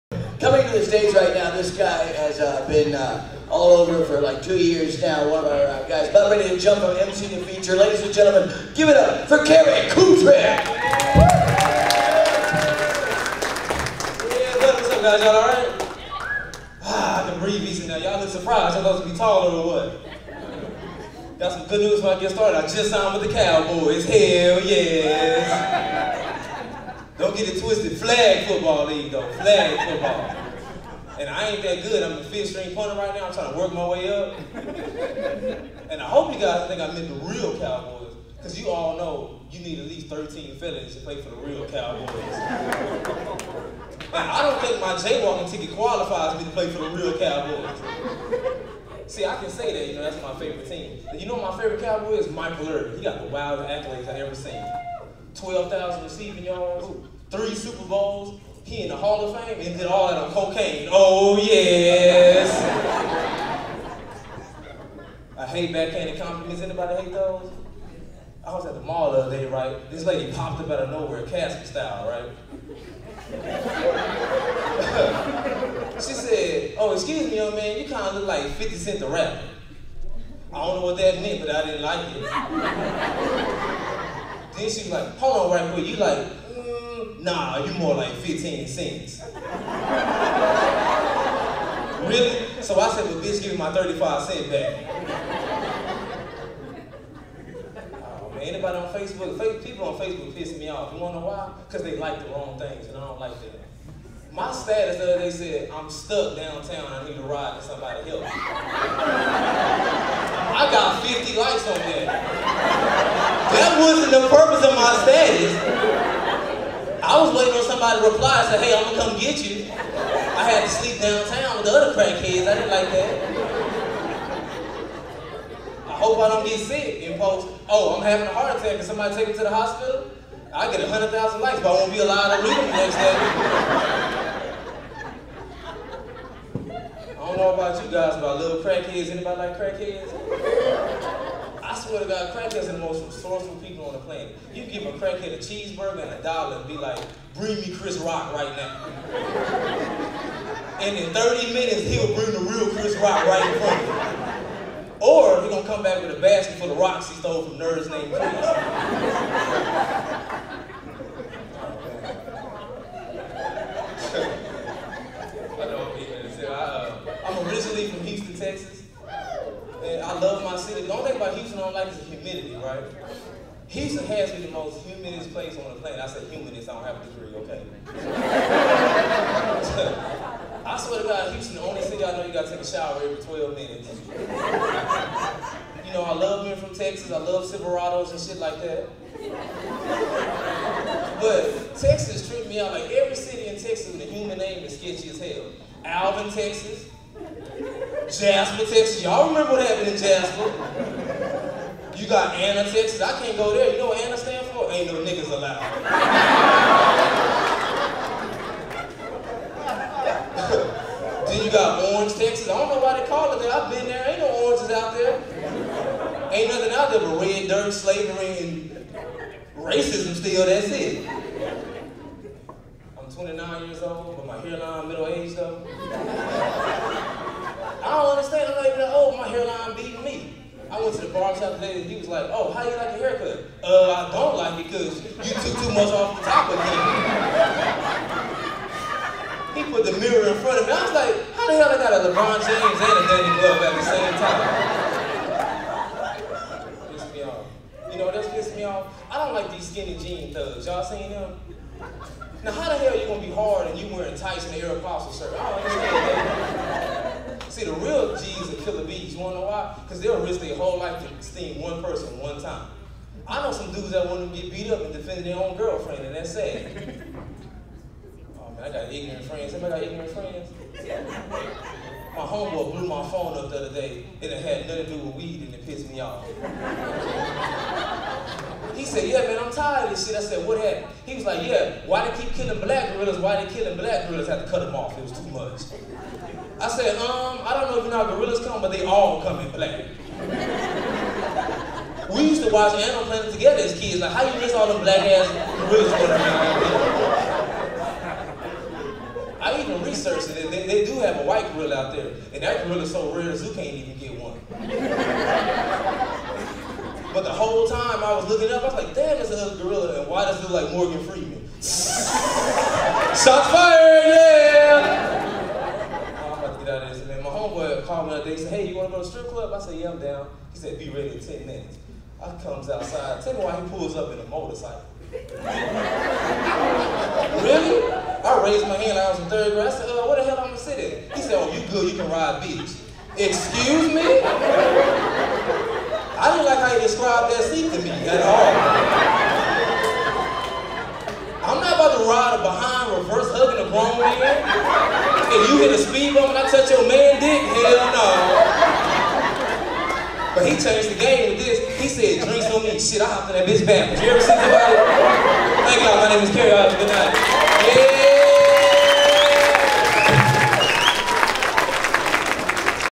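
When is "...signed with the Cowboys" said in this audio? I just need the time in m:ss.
0:22.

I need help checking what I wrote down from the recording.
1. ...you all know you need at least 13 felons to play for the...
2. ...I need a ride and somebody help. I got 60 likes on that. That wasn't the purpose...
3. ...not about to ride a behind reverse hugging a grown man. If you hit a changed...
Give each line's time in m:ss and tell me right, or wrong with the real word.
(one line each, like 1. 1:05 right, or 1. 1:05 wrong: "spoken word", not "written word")
1. 0:38 right
2. 1:46 wrong: "50", not "60"
3. 5:41 wrong: "speed", not "changed".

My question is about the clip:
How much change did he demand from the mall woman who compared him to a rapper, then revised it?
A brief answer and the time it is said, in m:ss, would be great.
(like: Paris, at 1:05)
35 cents, at 1:33.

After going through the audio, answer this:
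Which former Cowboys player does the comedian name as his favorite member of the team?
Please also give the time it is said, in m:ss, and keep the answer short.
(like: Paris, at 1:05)
Michael Irvin, at 0:52.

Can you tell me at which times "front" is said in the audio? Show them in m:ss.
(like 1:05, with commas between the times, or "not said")
2:33, 4:00.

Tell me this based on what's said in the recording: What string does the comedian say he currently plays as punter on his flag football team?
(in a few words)
fifth string.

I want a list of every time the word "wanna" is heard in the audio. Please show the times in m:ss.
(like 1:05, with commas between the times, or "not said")
1:40, 4:19.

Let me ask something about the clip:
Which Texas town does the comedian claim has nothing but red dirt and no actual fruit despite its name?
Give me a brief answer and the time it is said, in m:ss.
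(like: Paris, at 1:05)
Orange, Texas, at 3:31.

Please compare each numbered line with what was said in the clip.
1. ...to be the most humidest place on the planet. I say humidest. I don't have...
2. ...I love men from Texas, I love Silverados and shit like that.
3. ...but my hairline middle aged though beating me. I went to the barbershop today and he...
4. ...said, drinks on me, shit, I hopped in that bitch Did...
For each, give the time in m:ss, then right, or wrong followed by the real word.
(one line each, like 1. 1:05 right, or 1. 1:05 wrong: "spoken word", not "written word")
1. 2:54 right
2. 3:06 right
3. 3:44 right
4. 5:51 right.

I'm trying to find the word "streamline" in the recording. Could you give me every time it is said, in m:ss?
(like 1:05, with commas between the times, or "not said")
not said.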